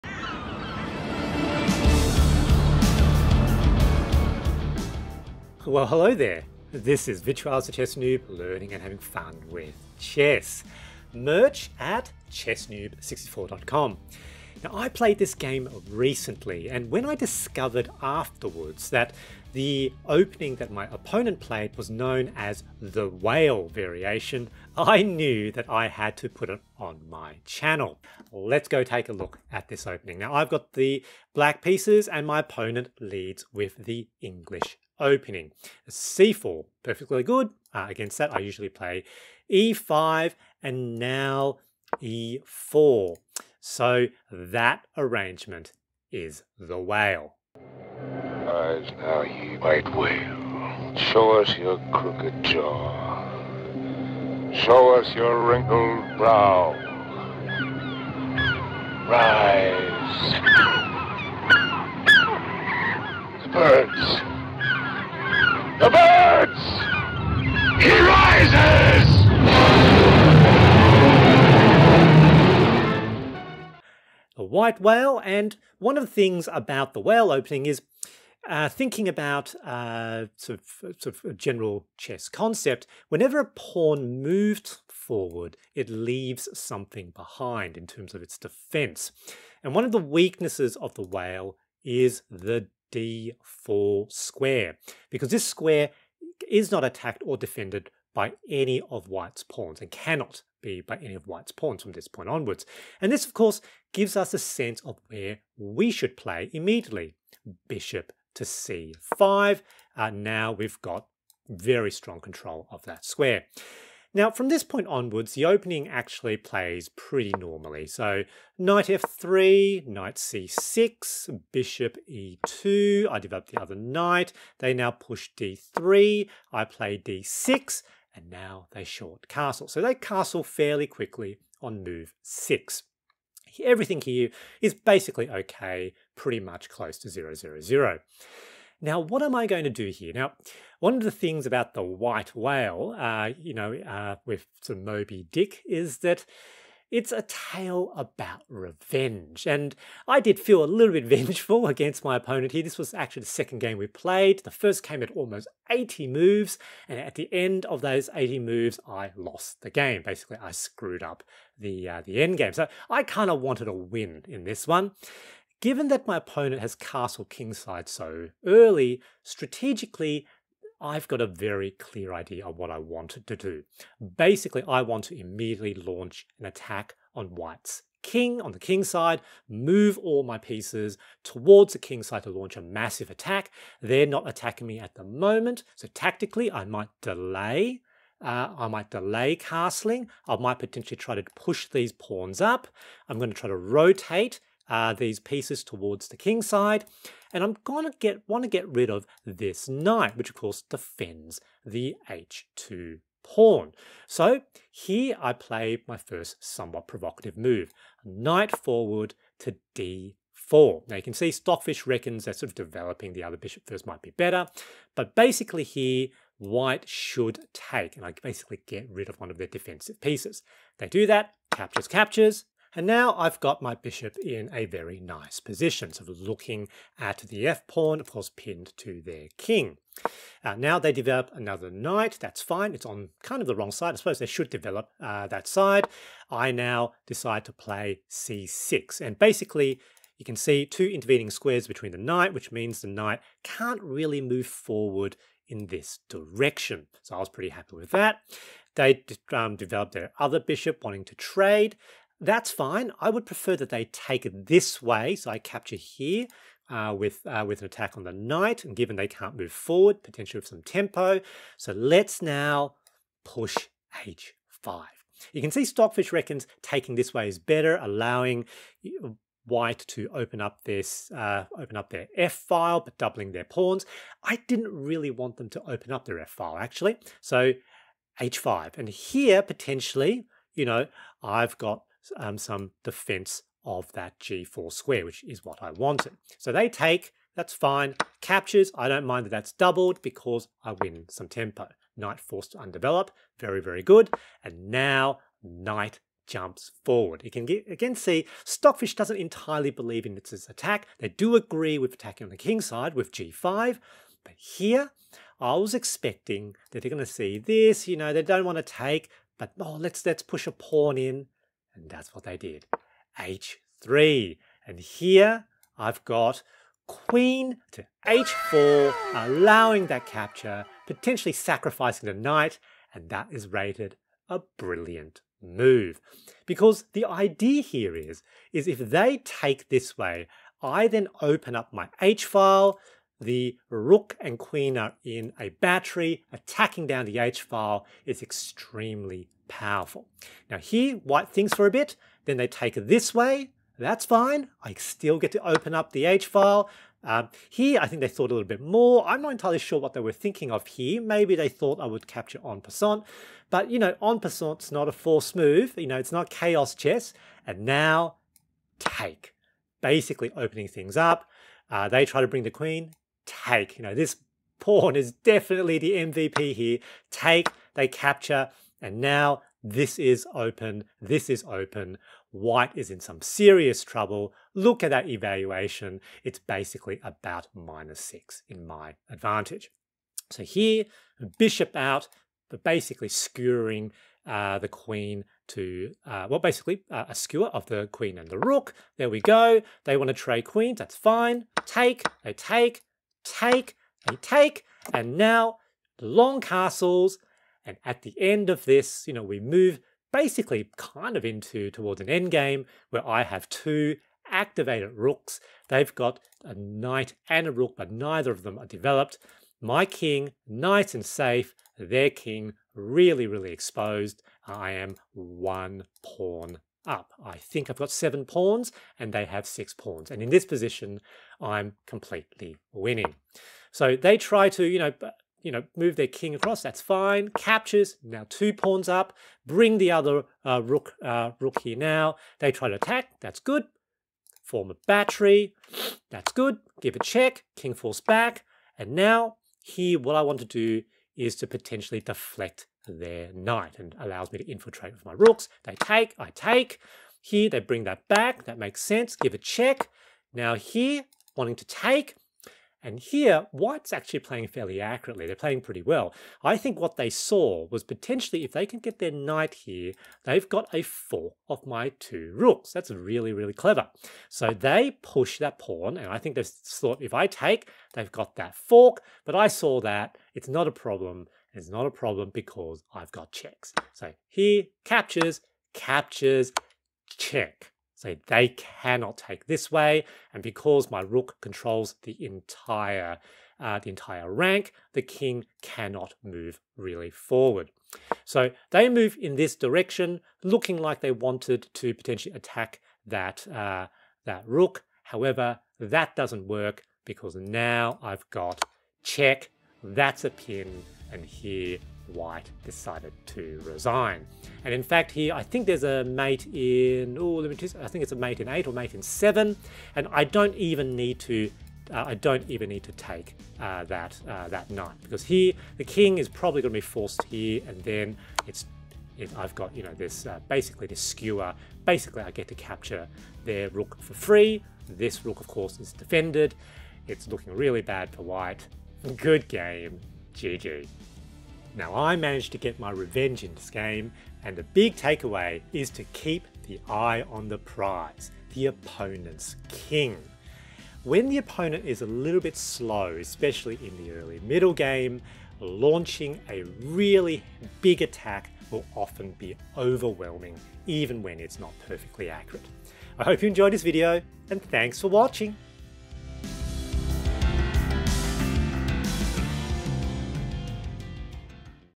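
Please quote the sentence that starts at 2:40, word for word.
Basically, I screwed up the, uh, the end game.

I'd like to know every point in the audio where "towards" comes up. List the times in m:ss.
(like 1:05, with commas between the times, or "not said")
3:01, 3:15, 6:41.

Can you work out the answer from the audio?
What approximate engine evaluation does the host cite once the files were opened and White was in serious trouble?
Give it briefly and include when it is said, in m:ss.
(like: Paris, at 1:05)
minus 6, at 6:17.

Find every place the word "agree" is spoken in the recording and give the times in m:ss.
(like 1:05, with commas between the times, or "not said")
5:01.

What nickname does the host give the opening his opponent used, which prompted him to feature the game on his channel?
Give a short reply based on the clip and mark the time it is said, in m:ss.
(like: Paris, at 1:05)
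whale variation, at 0:23.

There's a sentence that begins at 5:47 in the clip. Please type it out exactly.
Um, here, I think they thought a little bit more.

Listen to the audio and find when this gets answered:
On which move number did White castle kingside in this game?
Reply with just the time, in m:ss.
2:11.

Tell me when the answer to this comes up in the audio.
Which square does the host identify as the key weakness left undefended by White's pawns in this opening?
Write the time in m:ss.
1:32.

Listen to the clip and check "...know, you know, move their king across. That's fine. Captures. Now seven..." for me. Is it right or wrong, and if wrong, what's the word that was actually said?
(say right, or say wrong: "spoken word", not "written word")
wrong: "two", not "seven".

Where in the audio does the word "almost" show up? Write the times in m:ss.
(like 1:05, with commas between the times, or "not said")
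2:35.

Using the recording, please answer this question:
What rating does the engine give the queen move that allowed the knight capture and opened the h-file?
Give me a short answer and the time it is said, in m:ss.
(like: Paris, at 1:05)
brilliant move, at 5:24.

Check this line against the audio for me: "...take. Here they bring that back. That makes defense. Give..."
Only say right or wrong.
wrong.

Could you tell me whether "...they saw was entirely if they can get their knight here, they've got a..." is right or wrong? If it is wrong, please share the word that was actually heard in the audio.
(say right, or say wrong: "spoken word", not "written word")
wrong: "potentially", not "entirely".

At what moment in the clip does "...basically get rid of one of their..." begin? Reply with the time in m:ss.
3:38.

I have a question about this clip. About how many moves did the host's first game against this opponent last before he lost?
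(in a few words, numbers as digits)
80.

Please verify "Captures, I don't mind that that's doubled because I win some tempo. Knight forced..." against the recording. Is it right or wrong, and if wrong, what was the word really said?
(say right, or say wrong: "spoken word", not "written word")
right.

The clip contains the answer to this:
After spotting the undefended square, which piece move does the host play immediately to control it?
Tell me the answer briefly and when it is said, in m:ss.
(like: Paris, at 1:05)
Bishop to c5, at 1:47.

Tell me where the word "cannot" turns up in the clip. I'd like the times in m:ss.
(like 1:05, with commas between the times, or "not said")
1:39, 7:58, 8:05.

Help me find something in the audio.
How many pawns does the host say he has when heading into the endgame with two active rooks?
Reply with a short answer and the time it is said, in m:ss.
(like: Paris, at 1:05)
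7, at 6:57.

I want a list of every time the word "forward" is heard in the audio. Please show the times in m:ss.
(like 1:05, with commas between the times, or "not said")
1:24, 3:28, 4:04, 4:19, 4:56, 8:07.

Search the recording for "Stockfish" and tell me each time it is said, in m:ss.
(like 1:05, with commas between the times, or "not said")
3:31, 4:25, 4:58.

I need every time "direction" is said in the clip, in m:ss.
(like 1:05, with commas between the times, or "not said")
4:06, 8:09.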